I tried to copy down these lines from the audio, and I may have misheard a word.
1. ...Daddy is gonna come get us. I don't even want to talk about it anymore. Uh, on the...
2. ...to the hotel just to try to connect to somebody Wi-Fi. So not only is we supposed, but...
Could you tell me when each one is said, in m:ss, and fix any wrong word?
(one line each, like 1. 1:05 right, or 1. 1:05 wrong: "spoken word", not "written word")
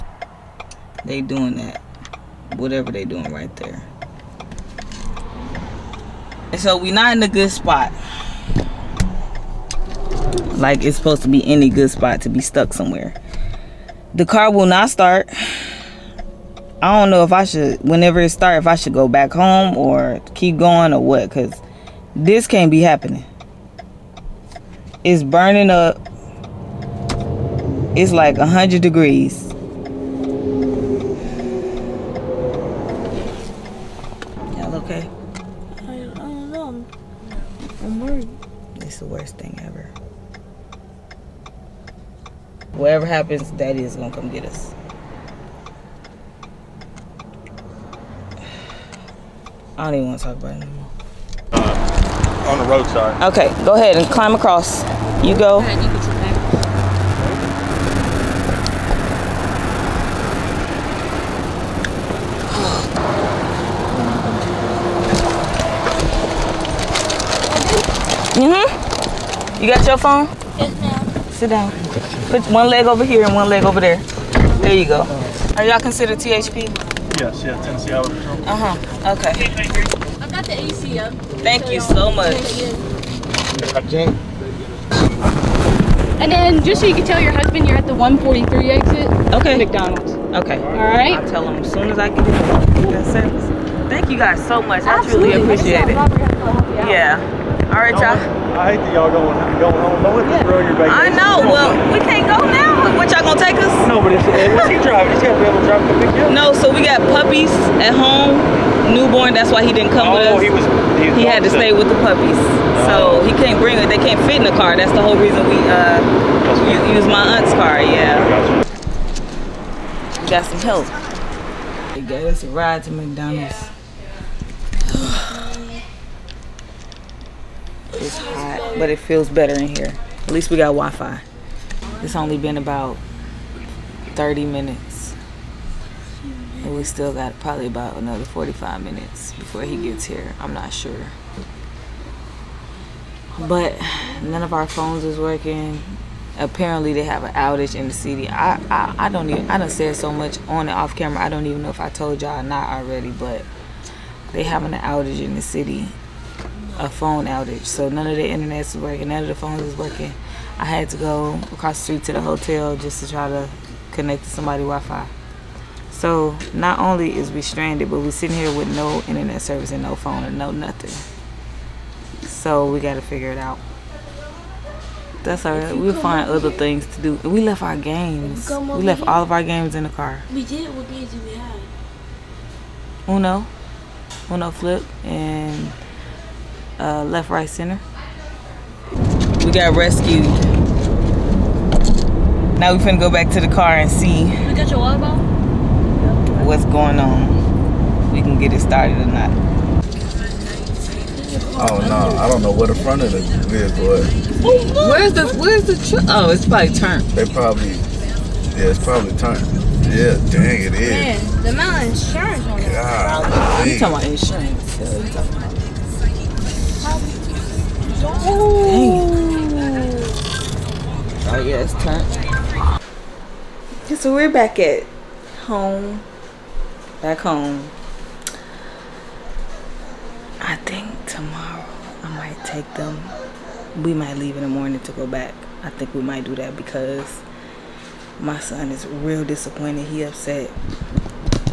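1. 0:43 right
2. 2:42 wrong: "stranded", not "supposed".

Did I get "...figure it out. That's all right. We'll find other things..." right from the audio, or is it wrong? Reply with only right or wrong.
right.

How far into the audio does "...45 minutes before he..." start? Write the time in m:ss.
2:18.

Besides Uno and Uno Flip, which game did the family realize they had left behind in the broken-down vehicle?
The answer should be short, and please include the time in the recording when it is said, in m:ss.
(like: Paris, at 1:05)
Left, Right, Center, at 3:07.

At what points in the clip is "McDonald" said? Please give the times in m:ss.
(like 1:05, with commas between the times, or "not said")
1:29, 2:02.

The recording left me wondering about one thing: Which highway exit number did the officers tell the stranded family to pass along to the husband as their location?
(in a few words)
143.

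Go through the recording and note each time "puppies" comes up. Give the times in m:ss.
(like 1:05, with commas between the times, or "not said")
1:47, 1:52.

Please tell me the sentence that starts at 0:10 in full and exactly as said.
Like it's supposed to be any good spot to be stuck somewhere.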